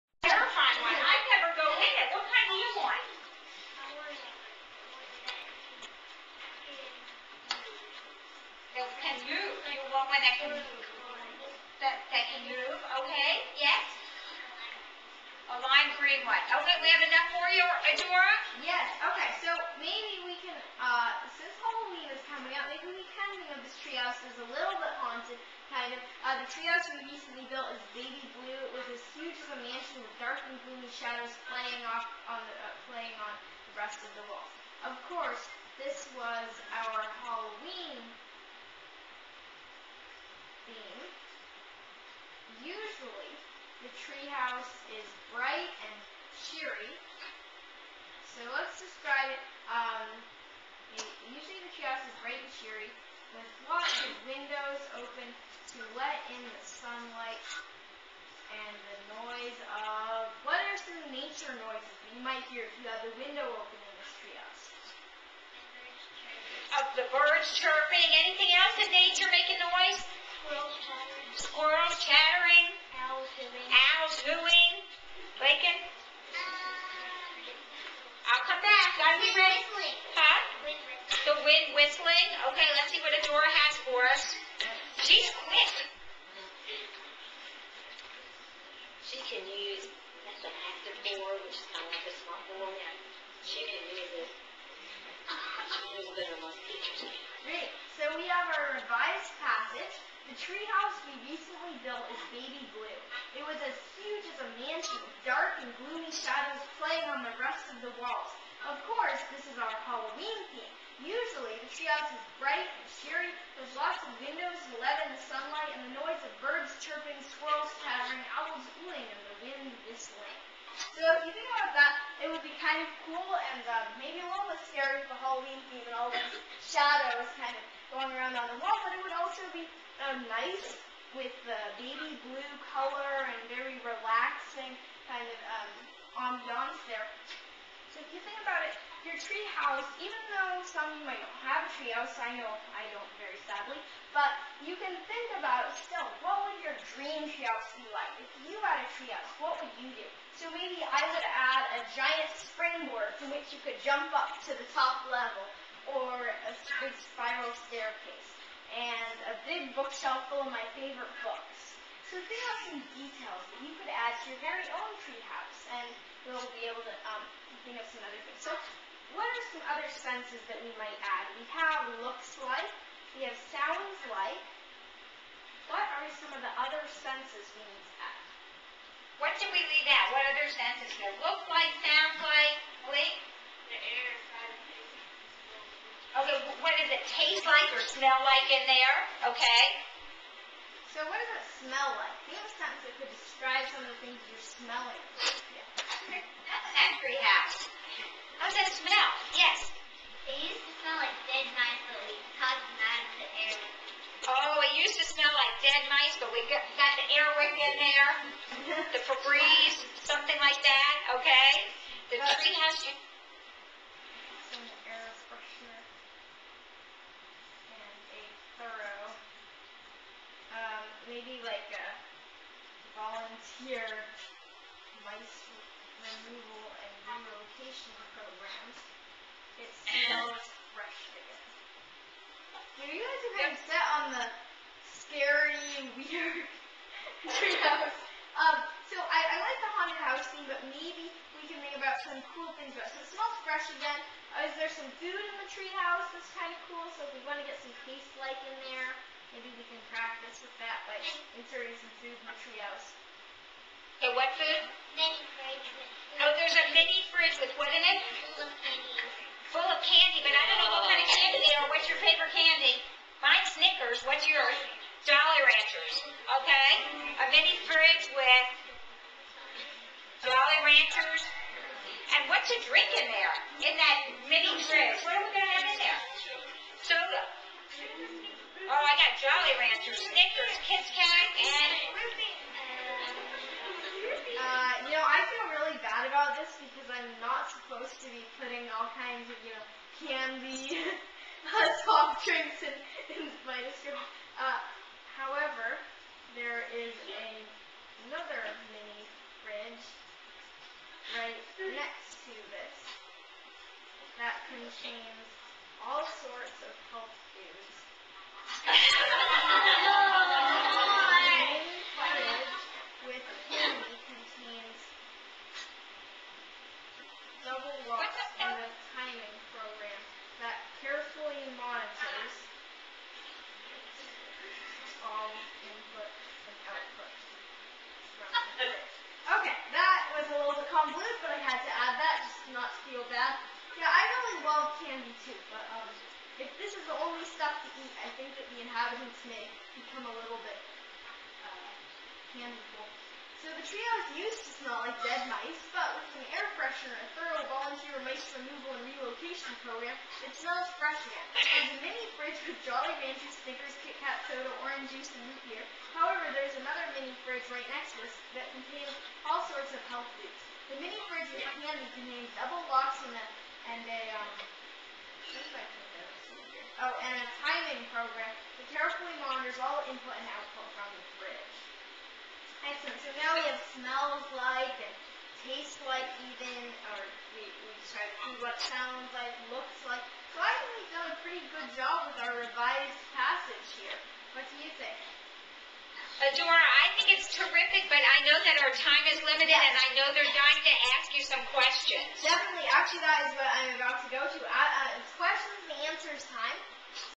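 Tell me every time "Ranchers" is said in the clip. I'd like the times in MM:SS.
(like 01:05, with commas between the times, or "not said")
04:25, 04:30, 04:39, 05:53.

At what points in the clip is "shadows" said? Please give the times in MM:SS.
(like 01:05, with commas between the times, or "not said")
00:30, 01:46, 02:06.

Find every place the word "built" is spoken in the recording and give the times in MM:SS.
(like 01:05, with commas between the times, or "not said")
00:27, 01:41.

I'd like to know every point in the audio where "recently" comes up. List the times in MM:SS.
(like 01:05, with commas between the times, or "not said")
00:27, 01:41.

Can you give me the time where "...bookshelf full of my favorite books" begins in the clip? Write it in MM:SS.
02:39.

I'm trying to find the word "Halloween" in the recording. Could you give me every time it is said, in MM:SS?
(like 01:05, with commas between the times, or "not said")
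00:21, 01:49, 02:05.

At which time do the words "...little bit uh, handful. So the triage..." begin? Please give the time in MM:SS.
05:40.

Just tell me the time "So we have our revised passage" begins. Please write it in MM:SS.
01:37.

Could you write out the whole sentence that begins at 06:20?
So I think we've done a pretty good job with our revised passage here.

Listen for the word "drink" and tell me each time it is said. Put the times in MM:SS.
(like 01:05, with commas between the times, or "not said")
04:32, 04:52.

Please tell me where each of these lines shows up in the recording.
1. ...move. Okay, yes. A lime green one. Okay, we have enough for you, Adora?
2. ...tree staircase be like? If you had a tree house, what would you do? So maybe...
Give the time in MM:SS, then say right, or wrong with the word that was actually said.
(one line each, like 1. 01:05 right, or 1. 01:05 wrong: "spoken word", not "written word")
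1. 00:12 right
2. 02:27 wrong: "house", not "staircase".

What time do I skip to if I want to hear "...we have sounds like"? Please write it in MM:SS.
02:53.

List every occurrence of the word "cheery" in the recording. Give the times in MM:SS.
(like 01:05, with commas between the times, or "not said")
00:52, 01:53.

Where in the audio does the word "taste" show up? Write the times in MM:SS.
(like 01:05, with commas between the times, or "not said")
03:07, 04:07, 06:15.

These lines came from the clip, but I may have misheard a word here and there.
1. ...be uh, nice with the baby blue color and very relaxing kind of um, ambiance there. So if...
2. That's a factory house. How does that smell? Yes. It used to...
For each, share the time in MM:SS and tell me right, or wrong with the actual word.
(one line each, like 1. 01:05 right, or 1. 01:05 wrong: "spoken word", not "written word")
1. 02:09 right
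2. 03:16 right.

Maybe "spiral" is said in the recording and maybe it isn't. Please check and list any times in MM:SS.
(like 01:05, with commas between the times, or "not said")
02:36.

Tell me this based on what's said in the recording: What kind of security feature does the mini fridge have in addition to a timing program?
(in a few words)
double locks.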